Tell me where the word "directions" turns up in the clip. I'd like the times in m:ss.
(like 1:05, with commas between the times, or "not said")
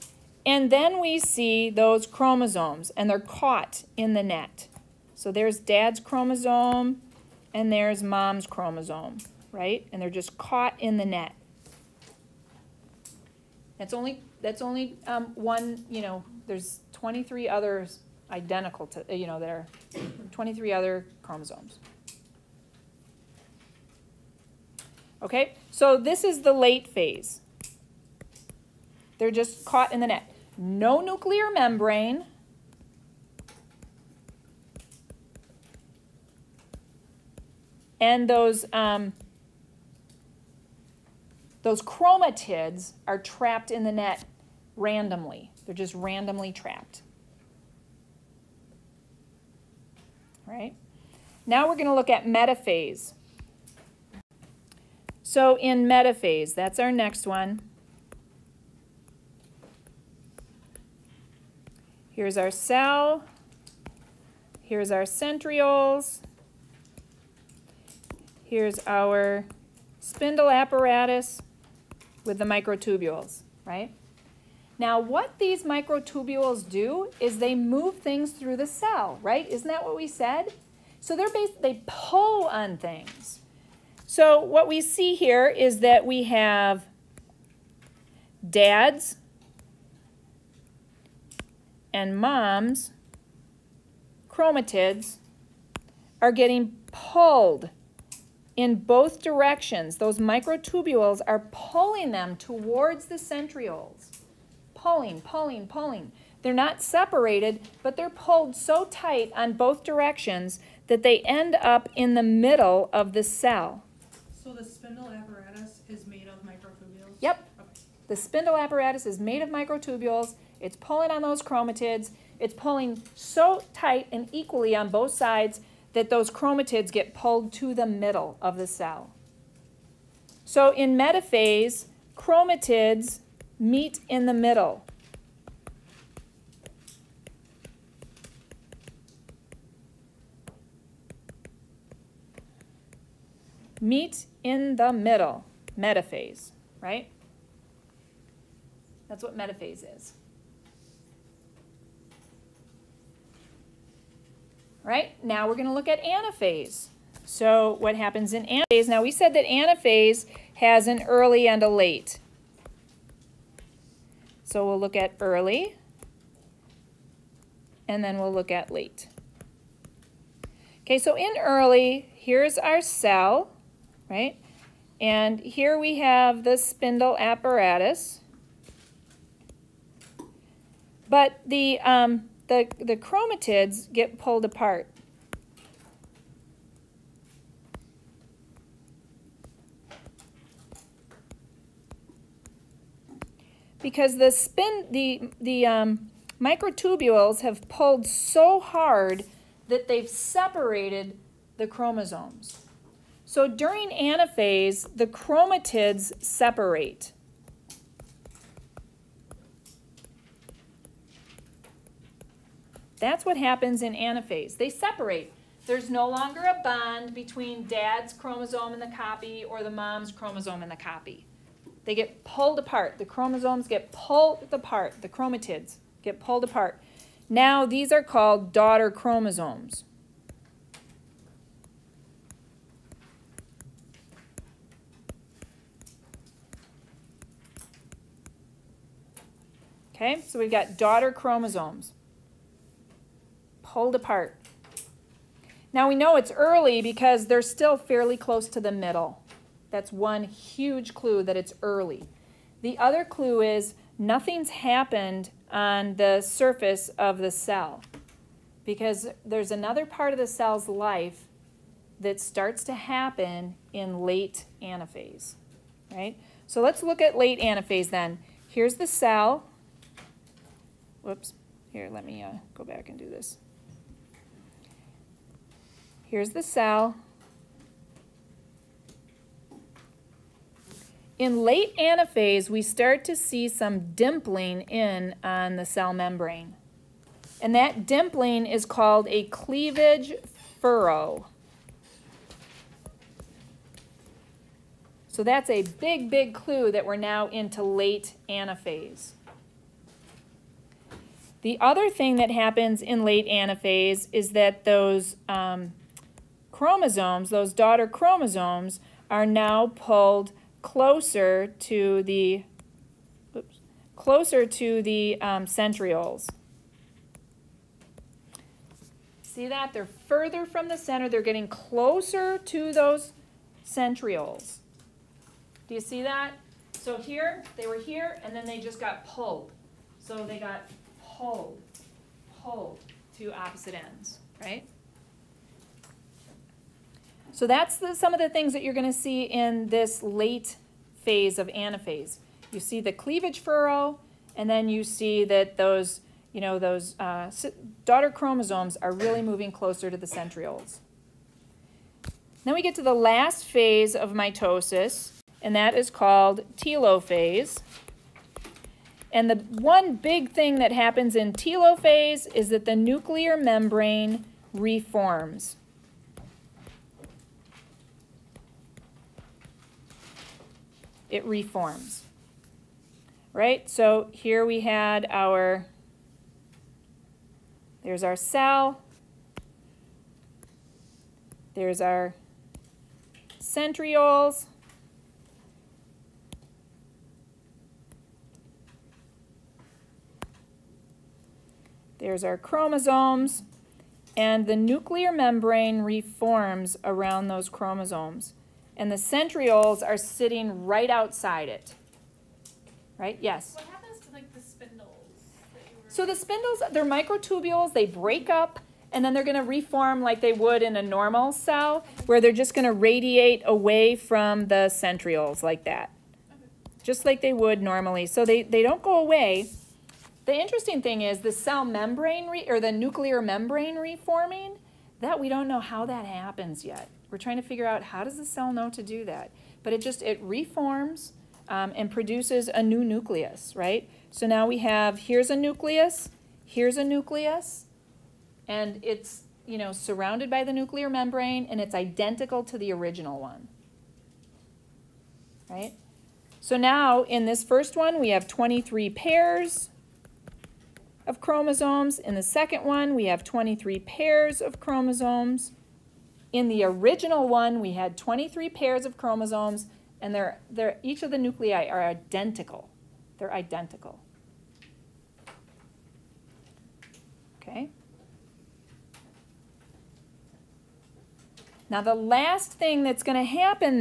1:39, 1:49.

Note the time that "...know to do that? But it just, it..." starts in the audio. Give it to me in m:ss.
7:08.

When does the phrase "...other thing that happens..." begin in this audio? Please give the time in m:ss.
5:01.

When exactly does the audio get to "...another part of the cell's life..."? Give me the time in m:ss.
4:19.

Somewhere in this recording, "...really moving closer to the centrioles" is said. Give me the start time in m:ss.
5:48.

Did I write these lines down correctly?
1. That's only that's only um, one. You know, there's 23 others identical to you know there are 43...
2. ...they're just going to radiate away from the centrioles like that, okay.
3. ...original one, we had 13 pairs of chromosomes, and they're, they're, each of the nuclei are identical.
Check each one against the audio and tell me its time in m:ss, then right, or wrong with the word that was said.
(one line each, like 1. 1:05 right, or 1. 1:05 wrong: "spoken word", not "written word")
1. 0:13 wrong: "23", not "43"
2. 6:52 right
3. 7:36 wrong: "23", not "13".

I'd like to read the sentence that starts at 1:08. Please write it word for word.
Here's our spindle apparatus with the microtubules, right?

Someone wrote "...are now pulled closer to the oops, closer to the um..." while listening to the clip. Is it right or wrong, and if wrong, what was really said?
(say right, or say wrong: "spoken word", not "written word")
right.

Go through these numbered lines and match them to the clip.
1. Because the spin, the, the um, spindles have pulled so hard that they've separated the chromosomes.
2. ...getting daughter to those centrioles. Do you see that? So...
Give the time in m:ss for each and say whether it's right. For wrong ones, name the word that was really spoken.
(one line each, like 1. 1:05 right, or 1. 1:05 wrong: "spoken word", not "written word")
1. 3:13 wrong: "microtubules", not "spindles"
2. 5:21 wrong: "closer", not "daughter".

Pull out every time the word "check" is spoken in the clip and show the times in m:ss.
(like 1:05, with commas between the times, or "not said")
not said.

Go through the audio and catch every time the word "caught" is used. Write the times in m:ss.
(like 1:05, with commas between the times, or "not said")
0:03, 0:10, 0:29.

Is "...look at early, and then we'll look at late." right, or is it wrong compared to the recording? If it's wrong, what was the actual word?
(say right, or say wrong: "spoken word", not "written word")
right.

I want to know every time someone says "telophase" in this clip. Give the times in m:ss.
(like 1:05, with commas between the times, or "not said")
5:56, 6:01.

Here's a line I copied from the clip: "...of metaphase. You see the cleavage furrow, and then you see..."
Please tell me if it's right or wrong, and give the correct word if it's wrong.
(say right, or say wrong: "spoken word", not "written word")
wrong: "anaphase", not "metaphase".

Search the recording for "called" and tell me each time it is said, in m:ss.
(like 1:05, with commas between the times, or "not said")
3:48, 4:48, 5:55.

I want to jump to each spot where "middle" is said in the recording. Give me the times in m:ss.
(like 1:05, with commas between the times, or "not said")
1:52, 2:07, 2:14, 2:24, 4:08.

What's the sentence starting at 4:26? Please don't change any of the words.
So let's look at late anaphase then.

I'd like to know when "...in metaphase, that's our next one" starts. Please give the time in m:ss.
0:55.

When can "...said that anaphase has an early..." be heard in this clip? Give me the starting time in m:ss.
2:39.